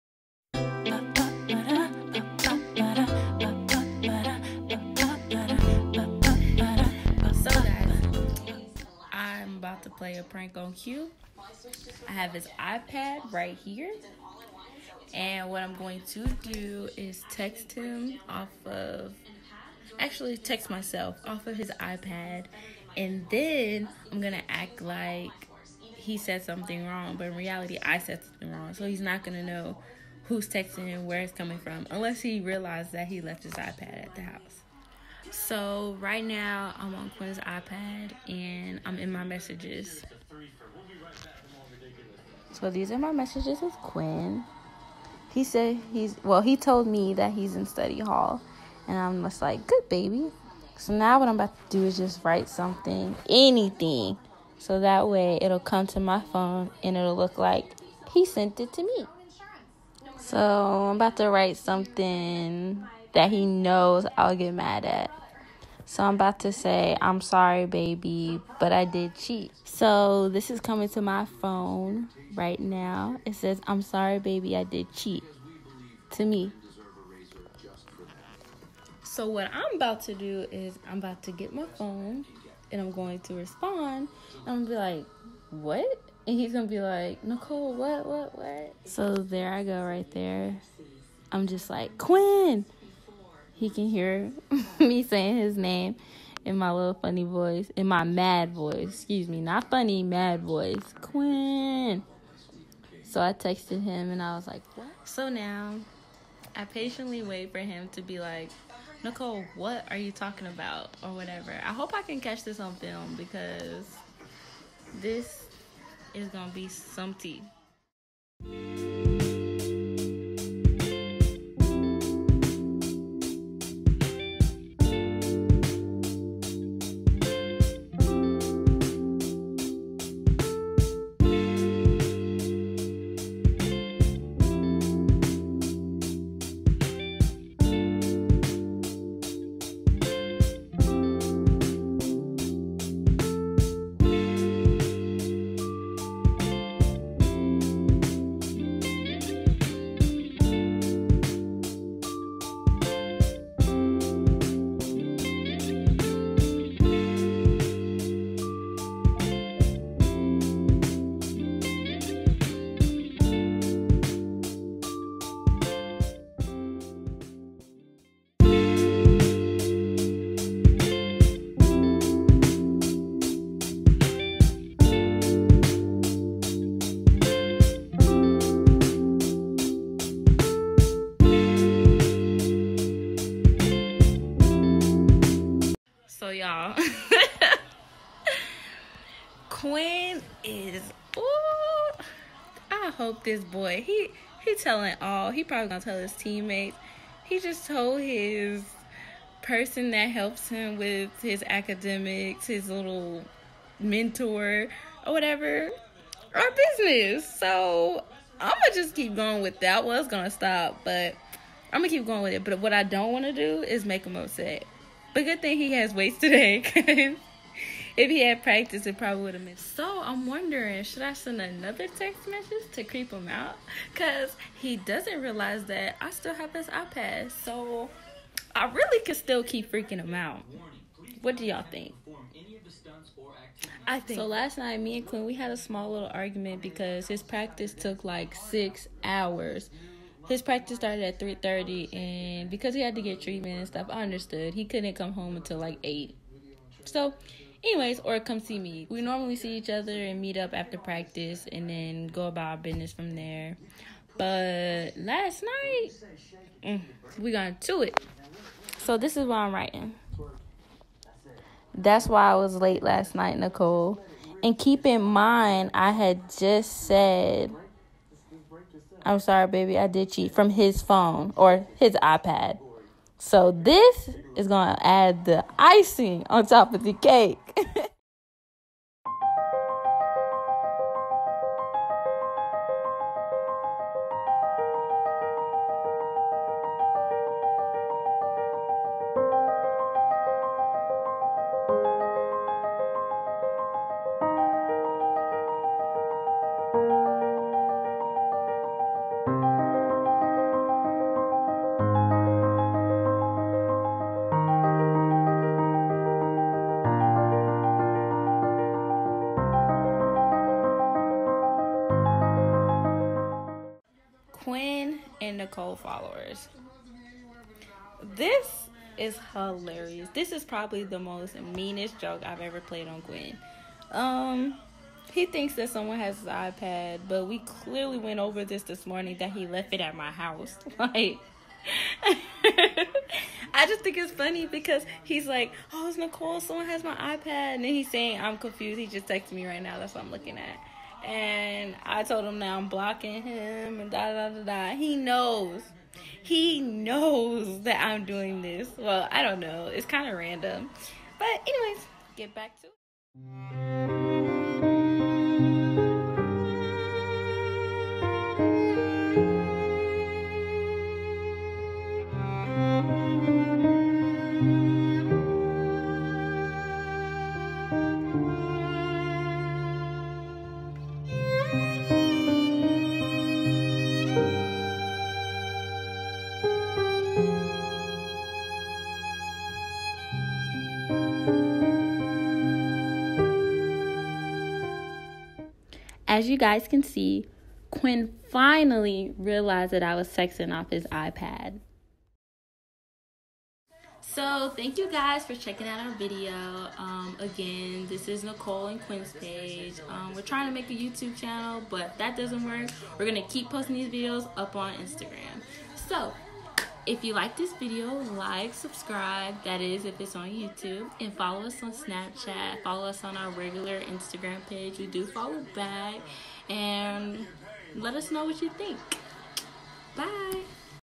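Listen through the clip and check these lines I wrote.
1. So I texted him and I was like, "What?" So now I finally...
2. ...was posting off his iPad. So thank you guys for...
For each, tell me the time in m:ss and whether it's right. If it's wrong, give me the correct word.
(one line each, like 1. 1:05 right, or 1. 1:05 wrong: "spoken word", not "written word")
1. 1:43 wrong: "patiently", not "finally"
2. 6:29 wrong: "sexting", not "posting".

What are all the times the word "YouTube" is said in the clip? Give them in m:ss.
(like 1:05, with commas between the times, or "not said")
6:40, 6:50.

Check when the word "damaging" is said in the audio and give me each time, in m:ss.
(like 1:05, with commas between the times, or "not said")
not said.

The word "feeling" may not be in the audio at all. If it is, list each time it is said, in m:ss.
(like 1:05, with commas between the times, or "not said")
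not said.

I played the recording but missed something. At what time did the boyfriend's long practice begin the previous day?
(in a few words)
3:30.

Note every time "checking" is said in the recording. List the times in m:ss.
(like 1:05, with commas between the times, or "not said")
6:35.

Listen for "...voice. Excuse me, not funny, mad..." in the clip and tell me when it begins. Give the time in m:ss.
1:38.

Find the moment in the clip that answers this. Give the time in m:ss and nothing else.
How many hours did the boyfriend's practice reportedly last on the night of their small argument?
3:58.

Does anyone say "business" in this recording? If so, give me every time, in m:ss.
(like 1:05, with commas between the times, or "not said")
3:26, 4:12.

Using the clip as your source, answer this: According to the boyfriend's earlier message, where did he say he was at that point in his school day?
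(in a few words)
Study hall.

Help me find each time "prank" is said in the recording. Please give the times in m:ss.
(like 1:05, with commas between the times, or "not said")
0:10.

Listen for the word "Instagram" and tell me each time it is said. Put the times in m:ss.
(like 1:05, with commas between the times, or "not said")
6:44, 6:53.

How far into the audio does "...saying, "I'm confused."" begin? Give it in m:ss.
5:37.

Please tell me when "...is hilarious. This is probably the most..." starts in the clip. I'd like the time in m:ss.
5:18.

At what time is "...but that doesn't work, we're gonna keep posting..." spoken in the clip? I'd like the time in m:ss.
6:41.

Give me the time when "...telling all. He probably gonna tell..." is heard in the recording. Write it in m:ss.
3:14.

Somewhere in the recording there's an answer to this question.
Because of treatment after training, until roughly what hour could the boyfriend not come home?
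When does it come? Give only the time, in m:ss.
4:05.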